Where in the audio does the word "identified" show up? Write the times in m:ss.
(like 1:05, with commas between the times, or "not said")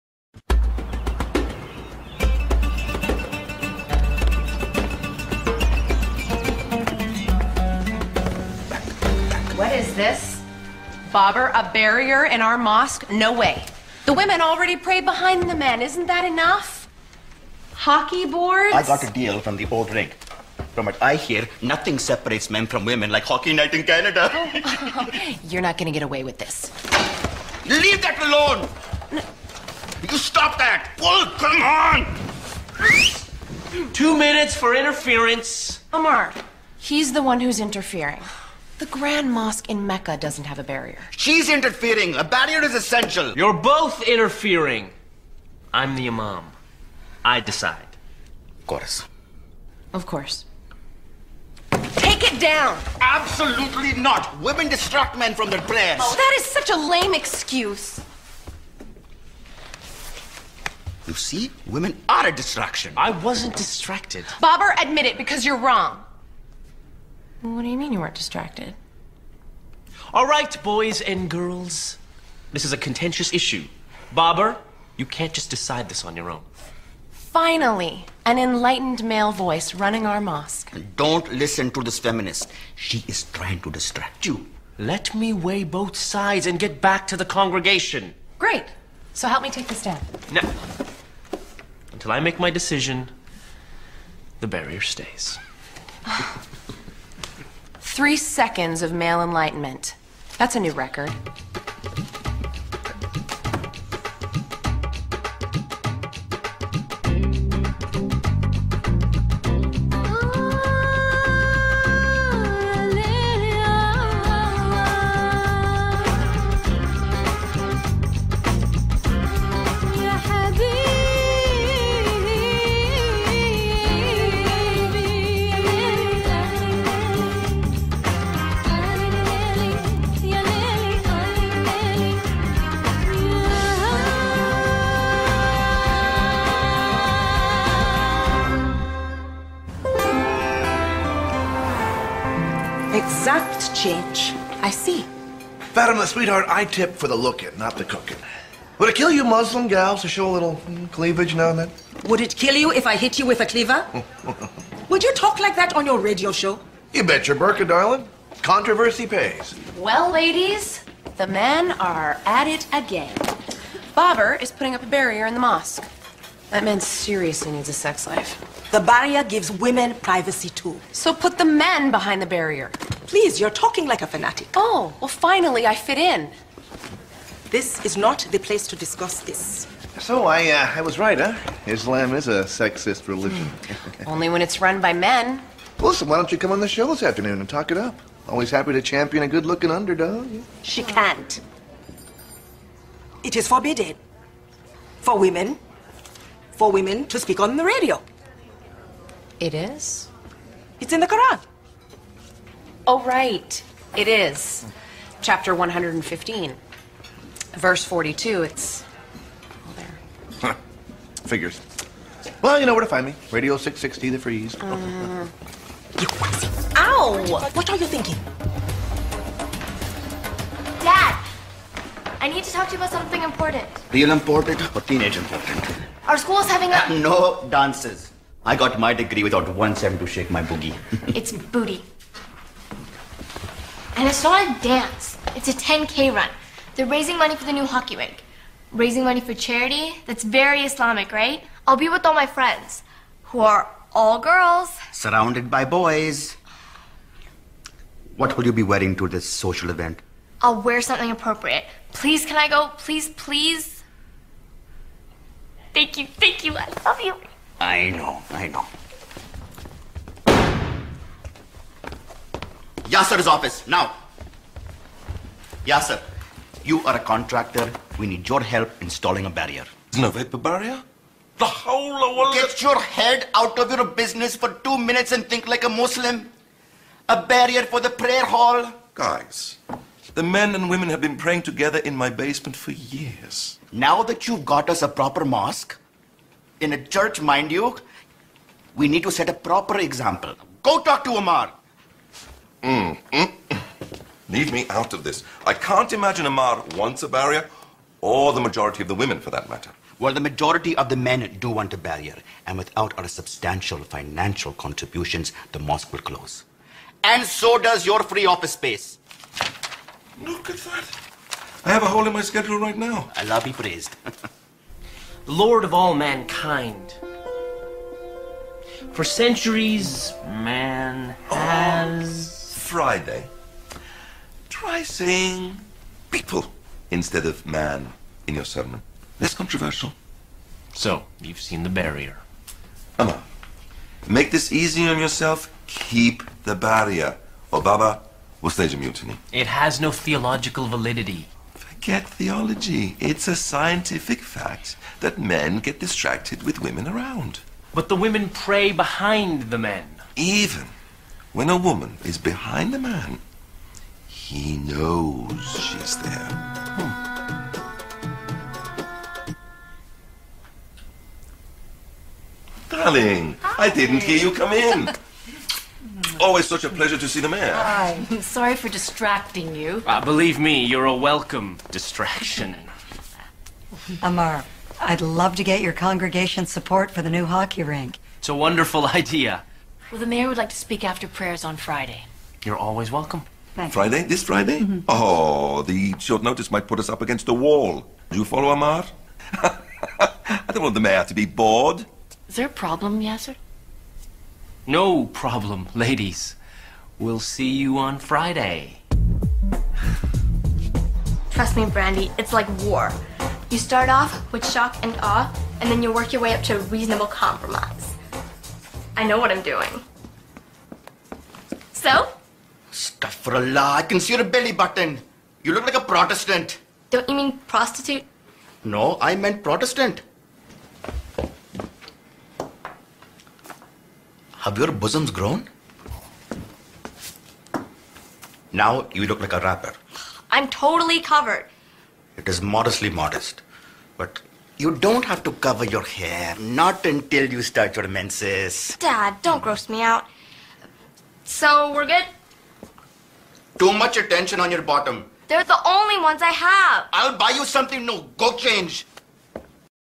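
not said.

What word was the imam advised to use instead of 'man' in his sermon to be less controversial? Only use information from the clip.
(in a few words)
People.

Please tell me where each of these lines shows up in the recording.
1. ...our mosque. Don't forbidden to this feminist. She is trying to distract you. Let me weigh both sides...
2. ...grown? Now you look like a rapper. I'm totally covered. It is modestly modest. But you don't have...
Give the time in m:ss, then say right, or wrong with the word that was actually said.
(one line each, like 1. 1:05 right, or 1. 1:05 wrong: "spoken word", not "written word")
1. 1:20 wrong: "listen", not "forbidden"
2. 7:05 right.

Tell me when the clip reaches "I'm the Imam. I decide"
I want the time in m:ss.
0:45.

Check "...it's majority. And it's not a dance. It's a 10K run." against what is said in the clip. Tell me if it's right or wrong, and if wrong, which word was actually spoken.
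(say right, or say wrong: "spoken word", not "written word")
wrong: "booty", not "majority".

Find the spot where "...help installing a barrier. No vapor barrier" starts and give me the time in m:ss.
4:28.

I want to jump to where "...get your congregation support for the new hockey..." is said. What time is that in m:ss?
6:15.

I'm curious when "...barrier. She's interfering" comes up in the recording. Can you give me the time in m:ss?
0:40.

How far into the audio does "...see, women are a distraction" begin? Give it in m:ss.
1:01.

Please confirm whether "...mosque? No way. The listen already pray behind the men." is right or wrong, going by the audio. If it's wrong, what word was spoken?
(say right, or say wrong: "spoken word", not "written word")
wrong: "women", not "listen".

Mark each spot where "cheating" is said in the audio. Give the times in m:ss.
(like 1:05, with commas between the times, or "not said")
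not said.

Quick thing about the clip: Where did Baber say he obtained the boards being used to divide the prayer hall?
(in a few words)
The old rink.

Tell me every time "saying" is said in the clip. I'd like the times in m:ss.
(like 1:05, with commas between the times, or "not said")
5:24.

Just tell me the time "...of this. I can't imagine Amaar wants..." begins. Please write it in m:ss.
4:54.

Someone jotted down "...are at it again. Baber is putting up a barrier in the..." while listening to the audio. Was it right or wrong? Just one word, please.
right.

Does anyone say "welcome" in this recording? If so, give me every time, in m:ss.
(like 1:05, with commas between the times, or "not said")
6:10, 6:22.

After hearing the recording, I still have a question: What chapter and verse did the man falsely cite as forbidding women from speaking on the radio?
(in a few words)
Chapter 115, verse 42.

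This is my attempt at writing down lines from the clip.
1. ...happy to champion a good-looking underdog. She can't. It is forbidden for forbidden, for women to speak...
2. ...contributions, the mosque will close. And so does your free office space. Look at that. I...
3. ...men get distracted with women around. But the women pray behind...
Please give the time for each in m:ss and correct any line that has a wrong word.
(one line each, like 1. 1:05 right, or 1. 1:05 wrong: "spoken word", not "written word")
1. 3:08 wrong: "women", not "forbidden"
2. 5:04 right
3. 5:45 right.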